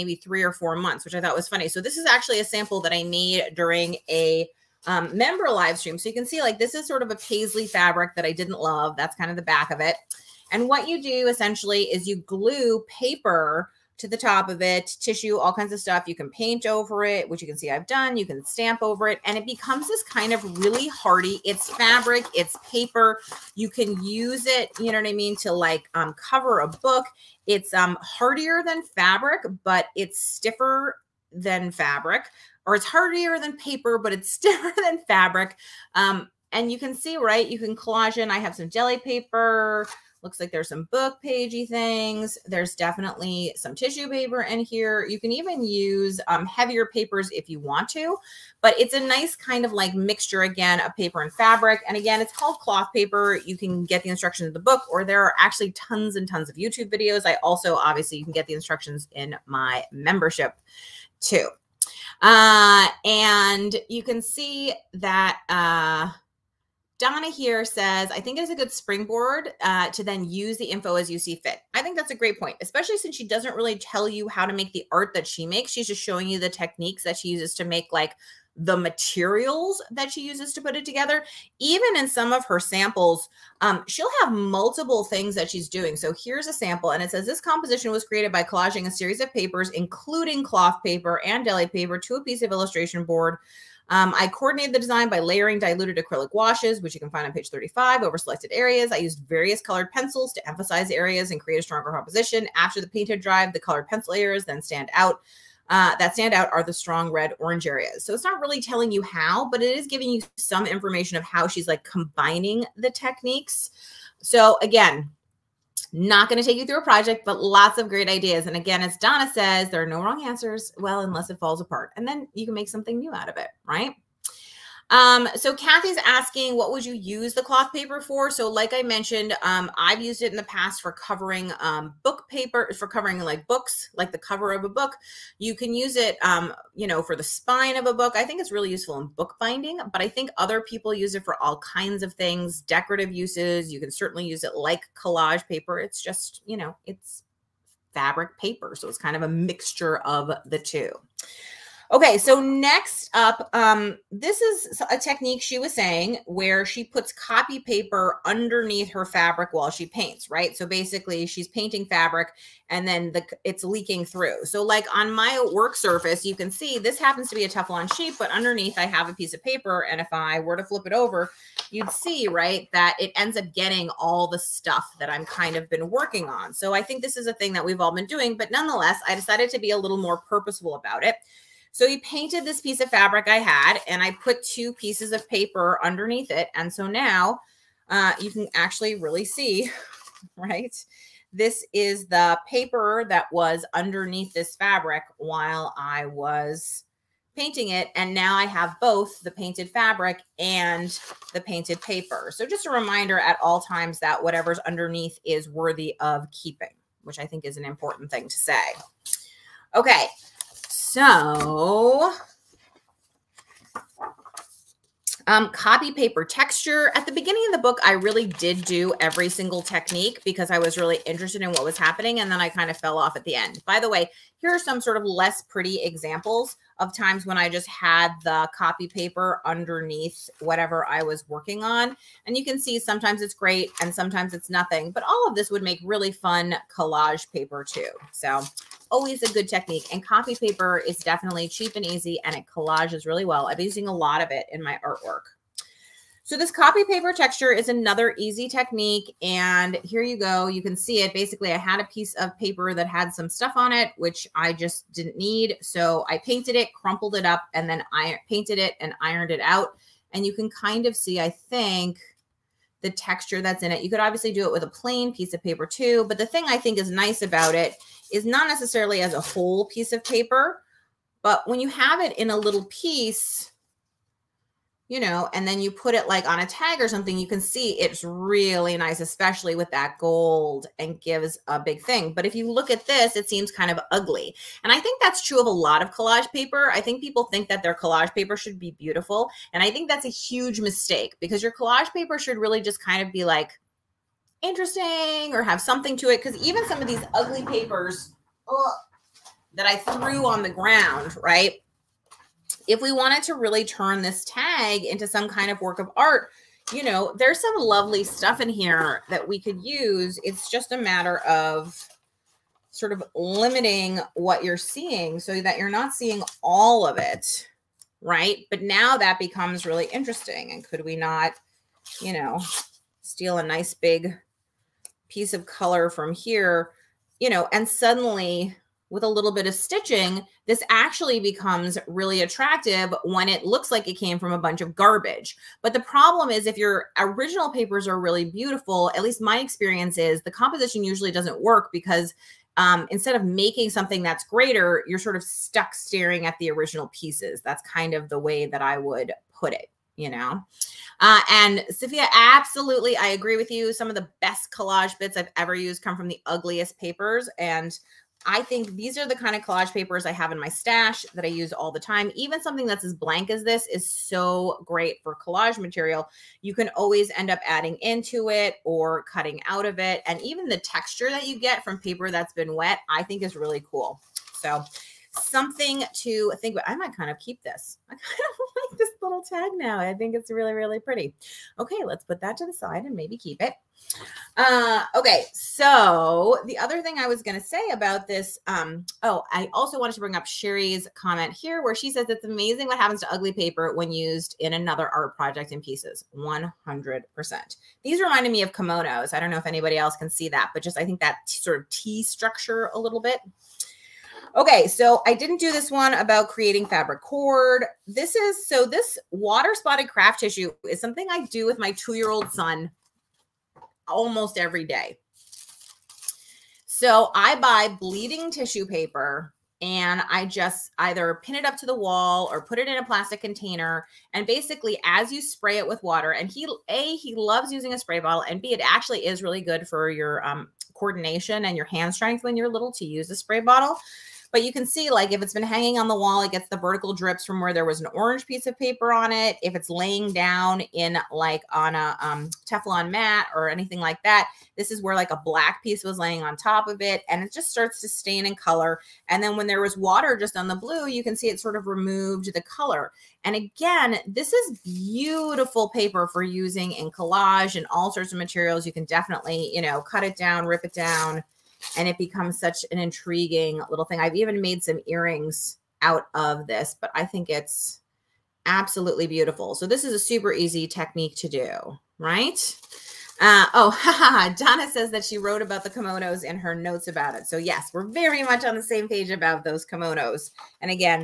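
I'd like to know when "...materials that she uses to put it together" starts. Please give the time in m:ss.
1:18.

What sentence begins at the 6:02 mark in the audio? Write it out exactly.
Even something that's as blank as this is so great for collage material.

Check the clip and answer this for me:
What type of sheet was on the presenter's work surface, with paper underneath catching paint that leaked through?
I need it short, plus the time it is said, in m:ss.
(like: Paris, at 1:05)
Teflon sheet, at 2:47.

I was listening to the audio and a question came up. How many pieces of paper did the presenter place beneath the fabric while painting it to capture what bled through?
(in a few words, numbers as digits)
2.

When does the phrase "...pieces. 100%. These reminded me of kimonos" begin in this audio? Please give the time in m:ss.
6:35.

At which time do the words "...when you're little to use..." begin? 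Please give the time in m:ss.
7:12.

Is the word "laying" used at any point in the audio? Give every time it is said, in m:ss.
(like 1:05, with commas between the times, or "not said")
7:19, 7:25.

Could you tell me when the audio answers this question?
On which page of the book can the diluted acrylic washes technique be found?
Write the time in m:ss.
1:37.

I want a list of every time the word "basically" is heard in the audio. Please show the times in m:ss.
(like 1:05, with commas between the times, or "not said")
2:40, 4:11, 7:04.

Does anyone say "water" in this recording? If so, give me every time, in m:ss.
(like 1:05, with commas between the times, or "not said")
6:49, 7:05, 7:29.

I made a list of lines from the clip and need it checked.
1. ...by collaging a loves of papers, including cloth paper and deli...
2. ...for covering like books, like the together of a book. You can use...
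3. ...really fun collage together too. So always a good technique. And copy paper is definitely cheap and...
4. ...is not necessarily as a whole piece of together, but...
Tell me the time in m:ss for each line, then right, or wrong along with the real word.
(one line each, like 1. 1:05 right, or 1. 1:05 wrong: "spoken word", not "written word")
1. 1:28 wrong: "series", not "loves"
2. 2:12 wrong: "cover", not "together"
3. 3:55 wrong: "paper", not "together"
4. 4:28 wrong: "paper", not "together".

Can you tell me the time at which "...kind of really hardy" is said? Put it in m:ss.
0:20.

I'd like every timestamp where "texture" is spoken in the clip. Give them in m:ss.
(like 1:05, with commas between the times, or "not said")
3:36, 4:07, 4:22, 6:10.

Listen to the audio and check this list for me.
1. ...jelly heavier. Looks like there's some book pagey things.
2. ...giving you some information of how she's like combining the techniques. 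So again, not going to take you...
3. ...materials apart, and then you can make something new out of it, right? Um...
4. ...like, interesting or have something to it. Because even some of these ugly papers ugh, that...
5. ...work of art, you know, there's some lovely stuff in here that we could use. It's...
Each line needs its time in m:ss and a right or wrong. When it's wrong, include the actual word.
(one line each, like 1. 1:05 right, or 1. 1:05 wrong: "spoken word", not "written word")
1. 0:38 wrong: "paper", not "heavier"
2. 1:49 right
3. 2:01 wrong: "falls", not "materials"
4. 4:53 right
5. 5:05 right.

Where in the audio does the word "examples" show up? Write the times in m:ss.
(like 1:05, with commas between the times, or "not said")
3:45.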